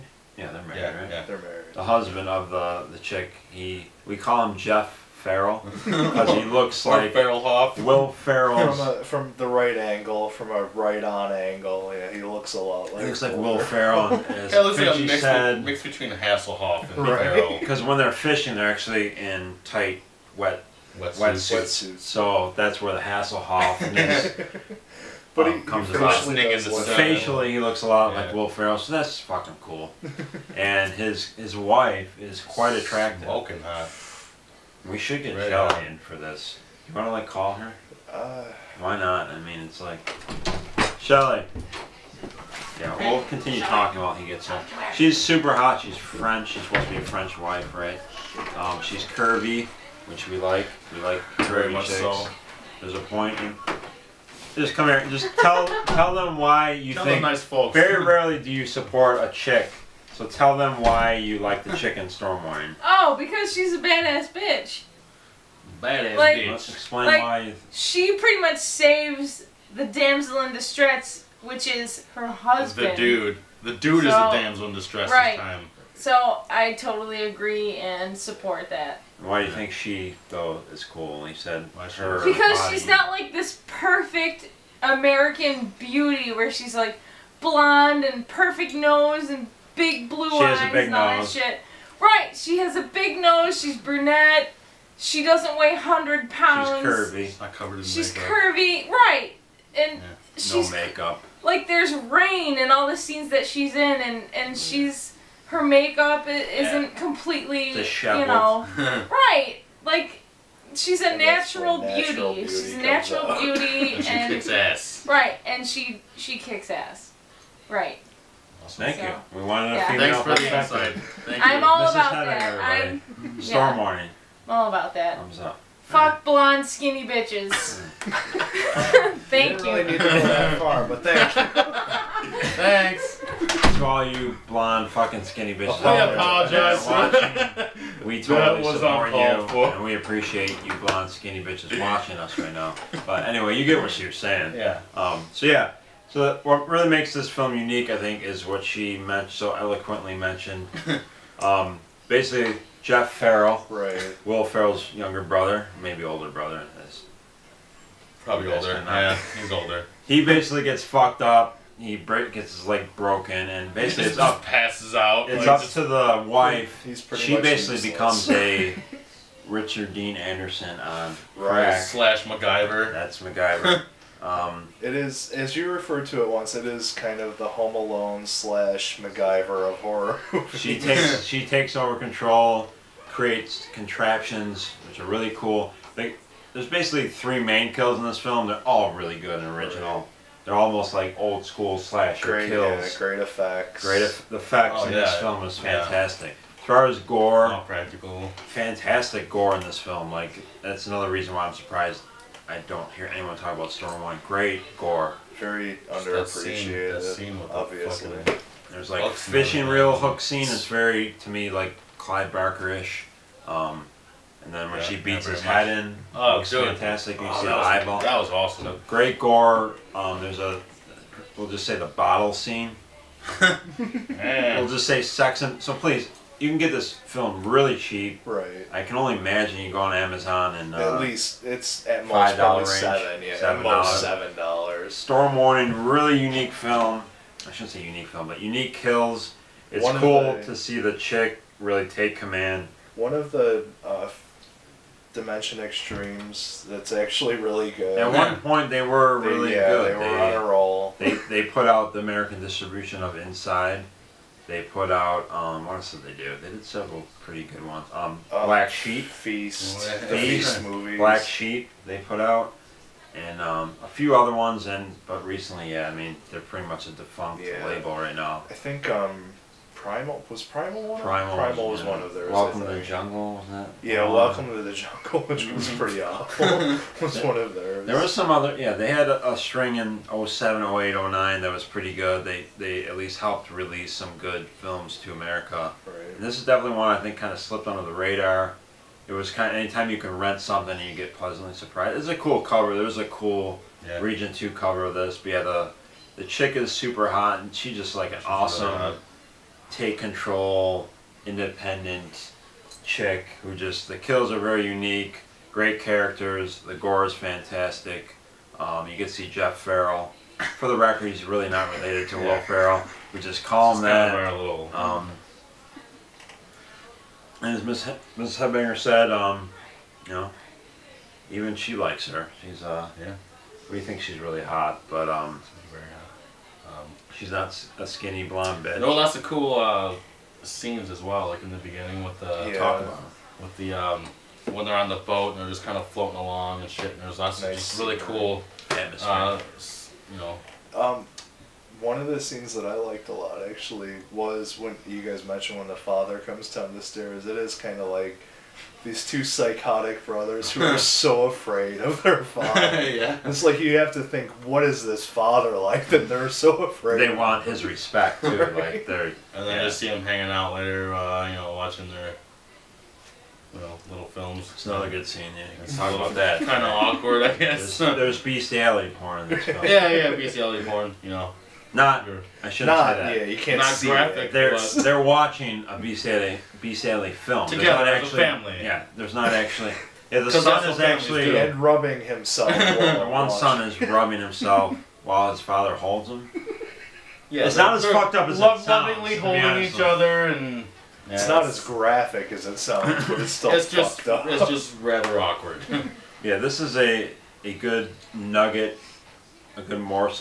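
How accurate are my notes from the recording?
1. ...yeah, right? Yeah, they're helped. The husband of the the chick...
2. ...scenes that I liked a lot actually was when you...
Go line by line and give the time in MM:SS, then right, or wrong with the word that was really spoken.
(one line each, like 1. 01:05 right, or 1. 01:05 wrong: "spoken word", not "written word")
1. 00:00 wrong: "married", not "helped"
2. 05:42 right.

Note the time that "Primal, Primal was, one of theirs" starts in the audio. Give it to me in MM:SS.
04:31.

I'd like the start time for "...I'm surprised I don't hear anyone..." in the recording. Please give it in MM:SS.
03:21.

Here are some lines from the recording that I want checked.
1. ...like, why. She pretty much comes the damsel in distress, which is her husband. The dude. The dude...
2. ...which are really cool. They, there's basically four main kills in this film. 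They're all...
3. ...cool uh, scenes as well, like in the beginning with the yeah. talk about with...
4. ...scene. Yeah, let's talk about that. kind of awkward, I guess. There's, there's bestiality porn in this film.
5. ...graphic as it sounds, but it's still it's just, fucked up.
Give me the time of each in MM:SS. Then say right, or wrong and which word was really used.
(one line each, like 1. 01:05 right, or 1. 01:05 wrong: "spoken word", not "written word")
1. 01:07 wrong: "saves", not "comes"
2. 03:04 wrong: "three", not "four"
3. 05:29 right
4. 06:05 right
5. 06:31 right.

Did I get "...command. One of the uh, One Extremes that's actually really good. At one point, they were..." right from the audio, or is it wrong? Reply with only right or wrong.
wrong.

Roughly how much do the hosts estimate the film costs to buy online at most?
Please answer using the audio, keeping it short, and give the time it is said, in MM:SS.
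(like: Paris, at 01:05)
$7, at 03:54.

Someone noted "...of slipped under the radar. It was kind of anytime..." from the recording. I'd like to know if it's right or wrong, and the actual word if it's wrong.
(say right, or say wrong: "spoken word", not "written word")
right.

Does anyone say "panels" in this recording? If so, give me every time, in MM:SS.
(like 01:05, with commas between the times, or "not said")
not said.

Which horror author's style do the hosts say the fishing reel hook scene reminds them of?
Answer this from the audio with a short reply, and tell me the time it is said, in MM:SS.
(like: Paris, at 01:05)
Clive Barker, at 03:31.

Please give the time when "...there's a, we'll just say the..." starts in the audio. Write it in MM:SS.
03:40.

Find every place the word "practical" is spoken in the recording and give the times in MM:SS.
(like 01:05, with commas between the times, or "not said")
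03:17.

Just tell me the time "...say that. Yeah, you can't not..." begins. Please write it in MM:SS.
06:12.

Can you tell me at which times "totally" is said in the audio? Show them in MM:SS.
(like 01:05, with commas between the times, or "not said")
01:16, 02:18.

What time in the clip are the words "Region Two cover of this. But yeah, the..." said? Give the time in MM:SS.
04:53.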